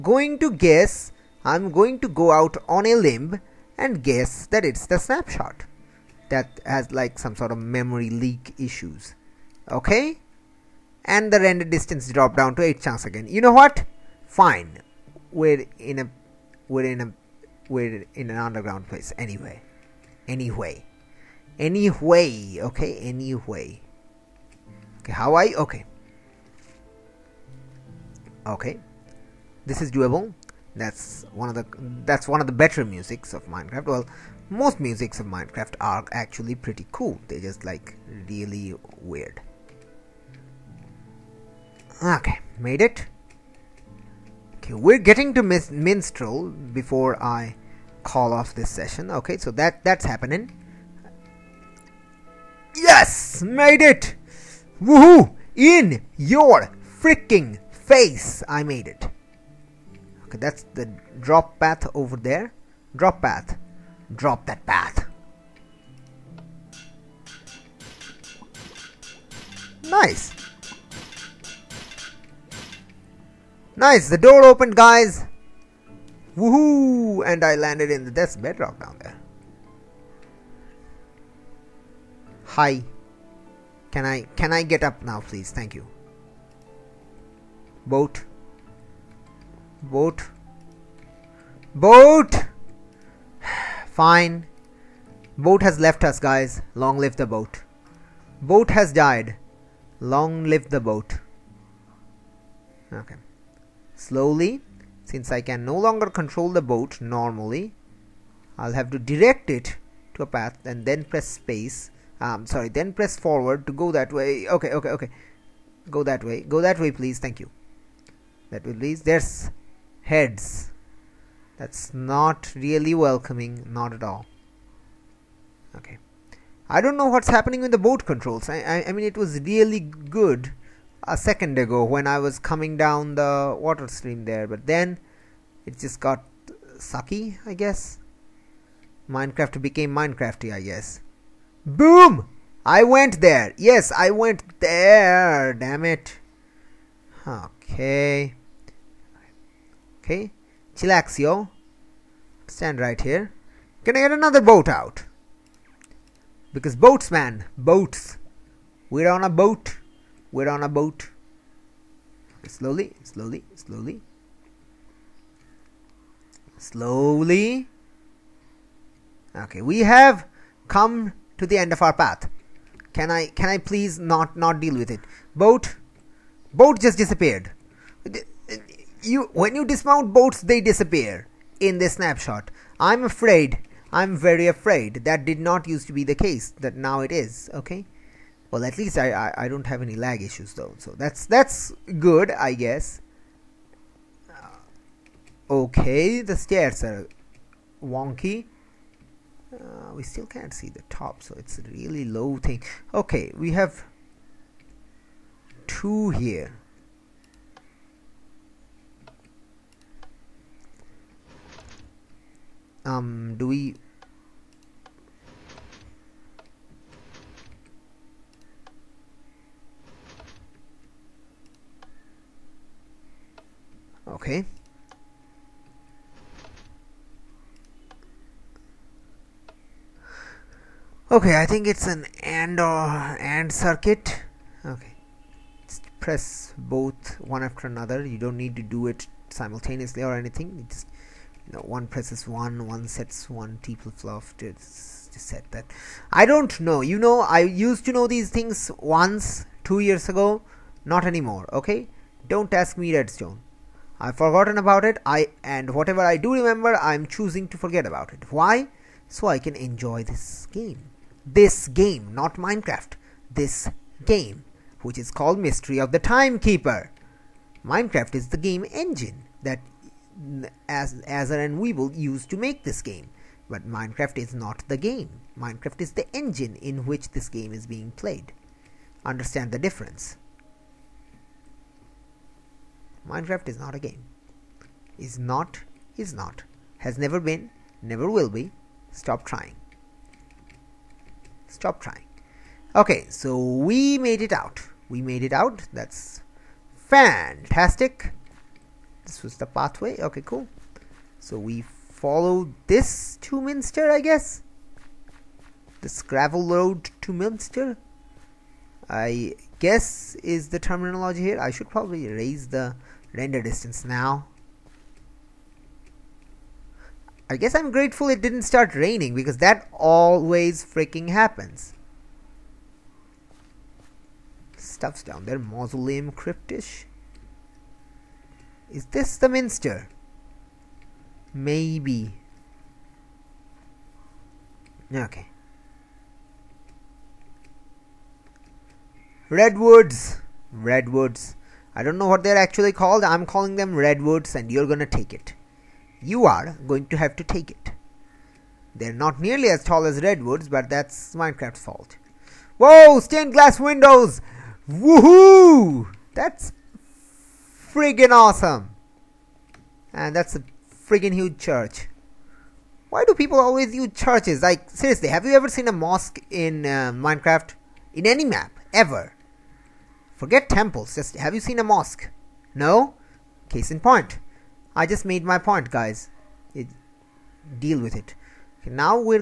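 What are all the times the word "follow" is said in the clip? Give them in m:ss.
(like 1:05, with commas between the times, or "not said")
5:01.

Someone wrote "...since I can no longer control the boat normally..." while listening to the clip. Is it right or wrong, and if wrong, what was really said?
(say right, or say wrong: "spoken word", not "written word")
right.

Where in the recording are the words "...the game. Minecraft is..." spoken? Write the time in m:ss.
4:34.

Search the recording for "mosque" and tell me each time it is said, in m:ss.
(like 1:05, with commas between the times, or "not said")
6:05, 6:11.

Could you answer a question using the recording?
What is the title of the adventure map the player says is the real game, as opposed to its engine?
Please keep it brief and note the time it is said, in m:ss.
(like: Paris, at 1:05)
Mystery of the Timekeeper, at 4:25.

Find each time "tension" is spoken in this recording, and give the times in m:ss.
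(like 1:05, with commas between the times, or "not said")
not said.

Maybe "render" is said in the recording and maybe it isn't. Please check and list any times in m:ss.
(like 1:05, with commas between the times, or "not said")
0:11, 5:13.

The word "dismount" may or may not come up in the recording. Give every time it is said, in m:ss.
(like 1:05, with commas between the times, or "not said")
2:59.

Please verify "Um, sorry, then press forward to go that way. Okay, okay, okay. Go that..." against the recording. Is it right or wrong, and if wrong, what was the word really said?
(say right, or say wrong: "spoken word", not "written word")
right.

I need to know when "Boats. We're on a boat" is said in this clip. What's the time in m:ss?
2:37.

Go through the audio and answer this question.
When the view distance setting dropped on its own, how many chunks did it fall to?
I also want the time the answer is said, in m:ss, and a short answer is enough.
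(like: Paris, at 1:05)
8, at 0:12.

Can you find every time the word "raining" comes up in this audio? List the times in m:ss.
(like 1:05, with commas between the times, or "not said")
5:18.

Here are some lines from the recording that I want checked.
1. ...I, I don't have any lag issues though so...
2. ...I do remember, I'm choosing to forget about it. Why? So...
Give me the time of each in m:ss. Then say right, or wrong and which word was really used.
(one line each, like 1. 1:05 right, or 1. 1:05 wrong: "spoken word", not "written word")
1. 3:09 right
2. 4:16 right.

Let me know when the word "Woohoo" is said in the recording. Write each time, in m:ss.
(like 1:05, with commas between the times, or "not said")
0:54, 1:16, 5:54.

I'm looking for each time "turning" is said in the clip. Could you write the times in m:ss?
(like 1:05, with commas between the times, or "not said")
not said.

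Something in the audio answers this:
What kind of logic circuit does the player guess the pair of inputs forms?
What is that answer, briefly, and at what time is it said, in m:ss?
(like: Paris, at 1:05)
AND circuit, at 3:53.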